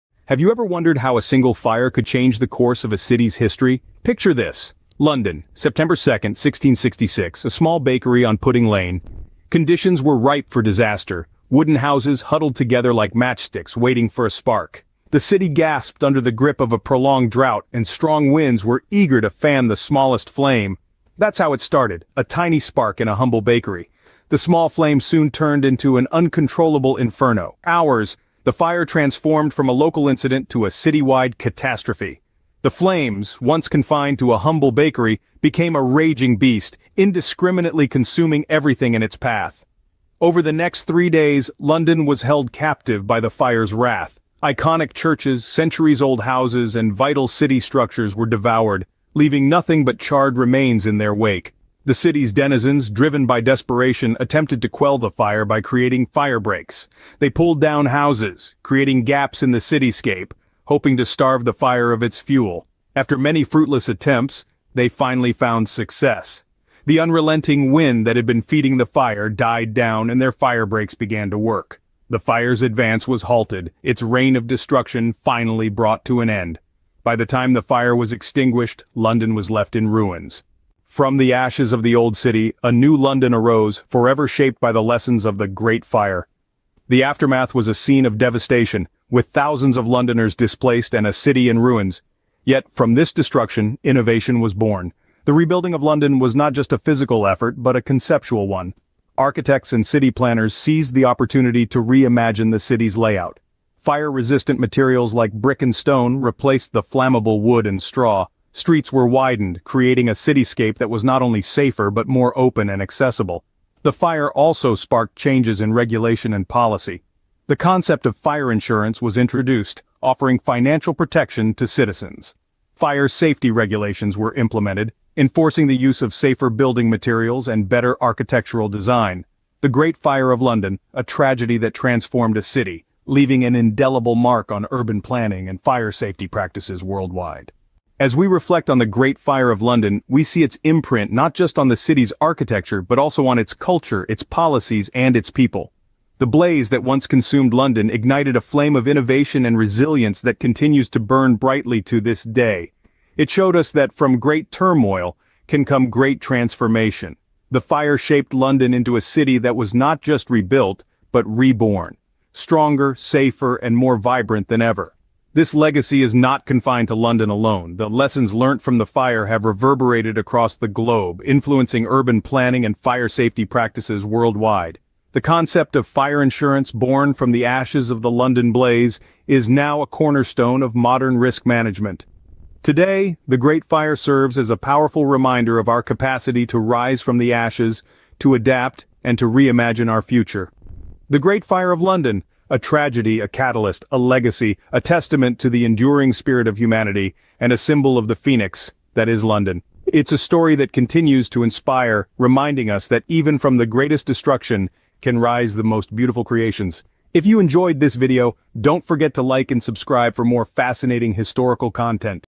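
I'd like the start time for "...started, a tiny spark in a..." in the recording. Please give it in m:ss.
0:21.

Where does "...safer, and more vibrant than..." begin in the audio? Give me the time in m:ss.
2:42.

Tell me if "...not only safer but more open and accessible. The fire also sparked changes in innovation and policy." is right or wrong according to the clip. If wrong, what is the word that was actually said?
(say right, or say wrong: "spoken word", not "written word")
wrong: "regulation", not "innovation".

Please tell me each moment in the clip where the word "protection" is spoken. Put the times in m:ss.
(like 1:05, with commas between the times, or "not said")
2:00.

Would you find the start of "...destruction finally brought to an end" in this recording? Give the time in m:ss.
1:14.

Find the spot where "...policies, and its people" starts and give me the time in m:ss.
2:24.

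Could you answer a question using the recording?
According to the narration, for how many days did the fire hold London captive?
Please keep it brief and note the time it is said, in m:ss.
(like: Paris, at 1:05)
3, at 0:40.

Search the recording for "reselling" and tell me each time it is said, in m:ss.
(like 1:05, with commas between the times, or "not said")
not said.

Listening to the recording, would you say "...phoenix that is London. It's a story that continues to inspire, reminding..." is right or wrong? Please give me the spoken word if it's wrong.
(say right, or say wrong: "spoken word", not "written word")
right.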